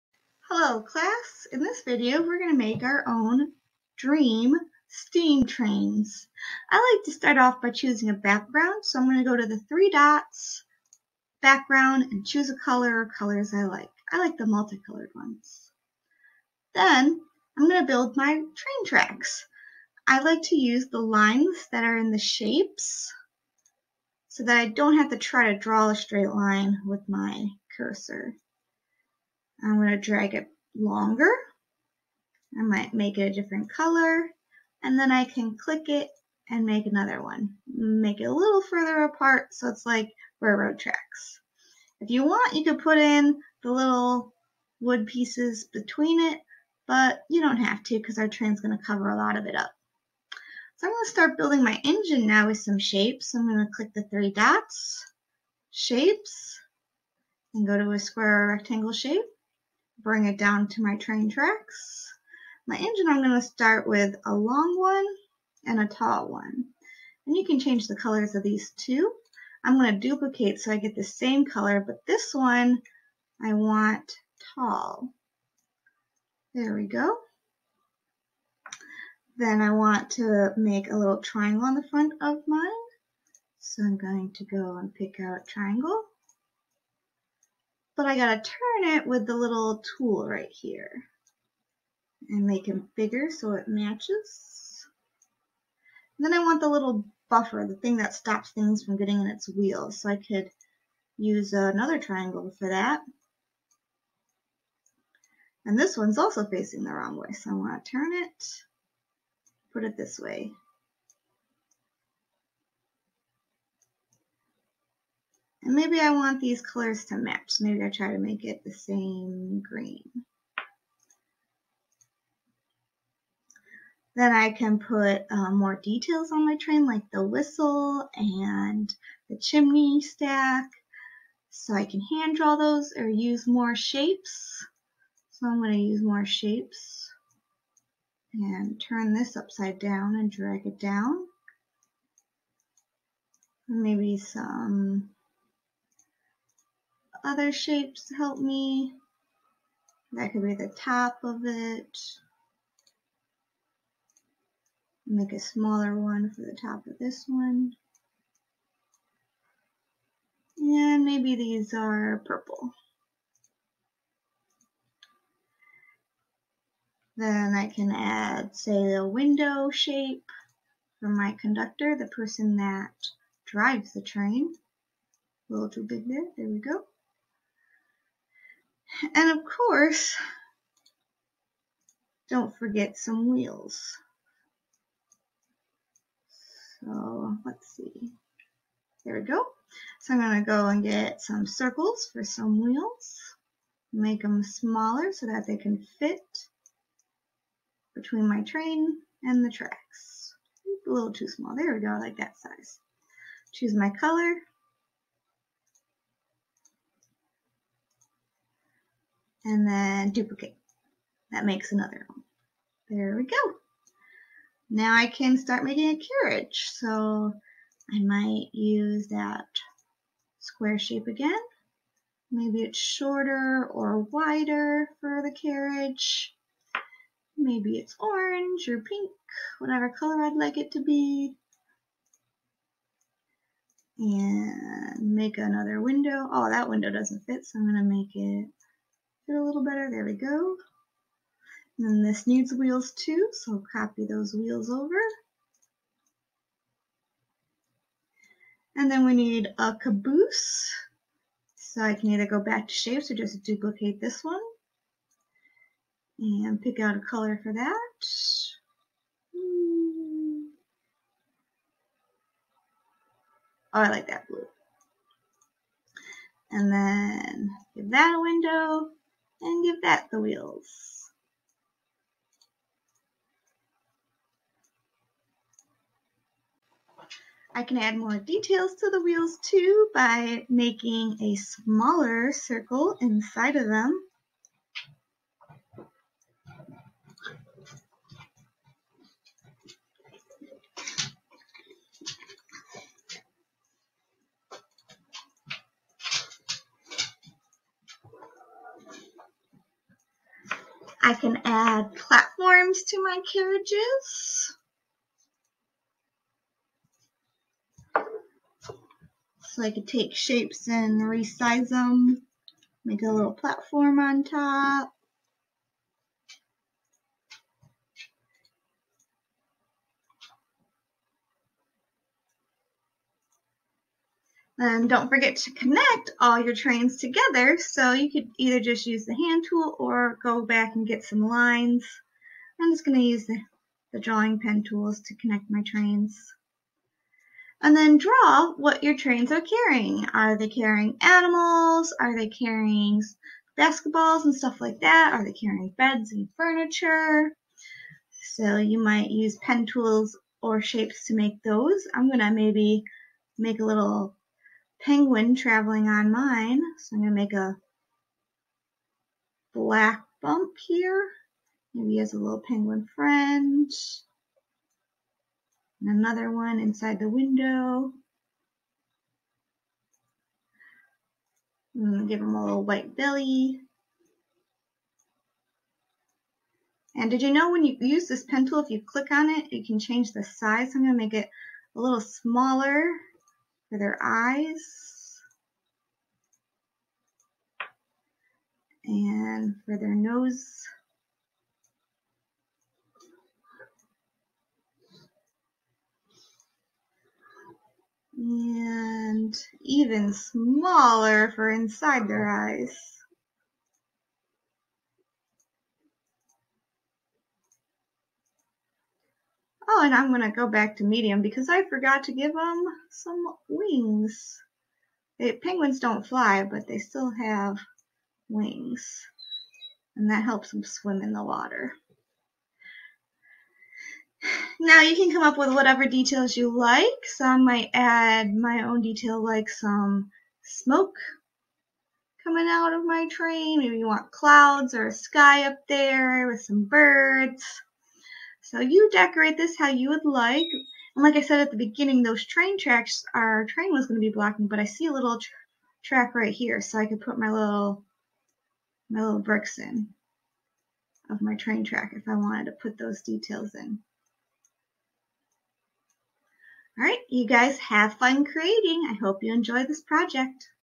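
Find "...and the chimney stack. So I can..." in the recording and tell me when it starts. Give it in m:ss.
2:08.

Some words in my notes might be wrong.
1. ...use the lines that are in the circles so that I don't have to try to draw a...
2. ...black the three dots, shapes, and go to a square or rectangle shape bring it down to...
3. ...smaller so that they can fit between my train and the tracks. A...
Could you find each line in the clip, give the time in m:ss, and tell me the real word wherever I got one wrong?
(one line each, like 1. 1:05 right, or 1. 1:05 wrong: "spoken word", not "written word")
1. 0:20 wrong: "shapes", not "circles"
2. 0:53 wrong: "click", not "black"
3. 3:14 right.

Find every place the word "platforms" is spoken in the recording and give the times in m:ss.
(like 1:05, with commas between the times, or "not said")
5:01, 5:13.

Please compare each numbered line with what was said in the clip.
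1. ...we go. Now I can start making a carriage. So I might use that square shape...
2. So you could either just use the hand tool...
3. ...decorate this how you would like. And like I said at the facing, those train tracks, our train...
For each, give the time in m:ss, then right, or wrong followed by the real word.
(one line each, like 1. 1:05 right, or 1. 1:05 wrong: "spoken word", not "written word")
1. 3:33 right
2. 5:27 right
3. 7:18 wrong: "beginning", not "facing".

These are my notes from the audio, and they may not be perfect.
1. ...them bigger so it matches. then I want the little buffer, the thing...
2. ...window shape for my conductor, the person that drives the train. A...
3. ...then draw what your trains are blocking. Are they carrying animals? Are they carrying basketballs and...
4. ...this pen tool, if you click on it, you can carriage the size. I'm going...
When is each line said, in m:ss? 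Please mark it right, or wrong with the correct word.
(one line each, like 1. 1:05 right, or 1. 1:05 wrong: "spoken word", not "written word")
1. 1:32 right
2. 2:49 right
3. 5:37 wrong: "carrying", not "blocking"
4. 6:18 wrong: "change", not "carriage".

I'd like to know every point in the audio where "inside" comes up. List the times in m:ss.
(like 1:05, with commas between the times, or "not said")
4:43, 6:06, 6:41.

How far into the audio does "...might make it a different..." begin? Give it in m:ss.
0:32.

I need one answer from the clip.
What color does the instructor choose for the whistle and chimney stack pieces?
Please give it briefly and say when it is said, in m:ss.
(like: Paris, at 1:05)
Purple, at 2:41.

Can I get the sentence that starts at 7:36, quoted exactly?
All right, you guys have fun creating.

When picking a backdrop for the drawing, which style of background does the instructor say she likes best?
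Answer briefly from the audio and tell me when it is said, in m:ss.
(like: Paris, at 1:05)
Multicolored ones, at 0:14.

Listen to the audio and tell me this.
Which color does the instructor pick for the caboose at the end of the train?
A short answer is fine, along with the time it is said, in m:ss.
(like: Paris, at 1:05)
Blue, at 4:23.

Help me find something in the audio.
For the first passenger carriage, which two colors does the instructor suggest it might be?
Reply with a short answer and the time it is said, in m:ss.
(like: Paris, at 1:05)
Orange or pink, at 3:47.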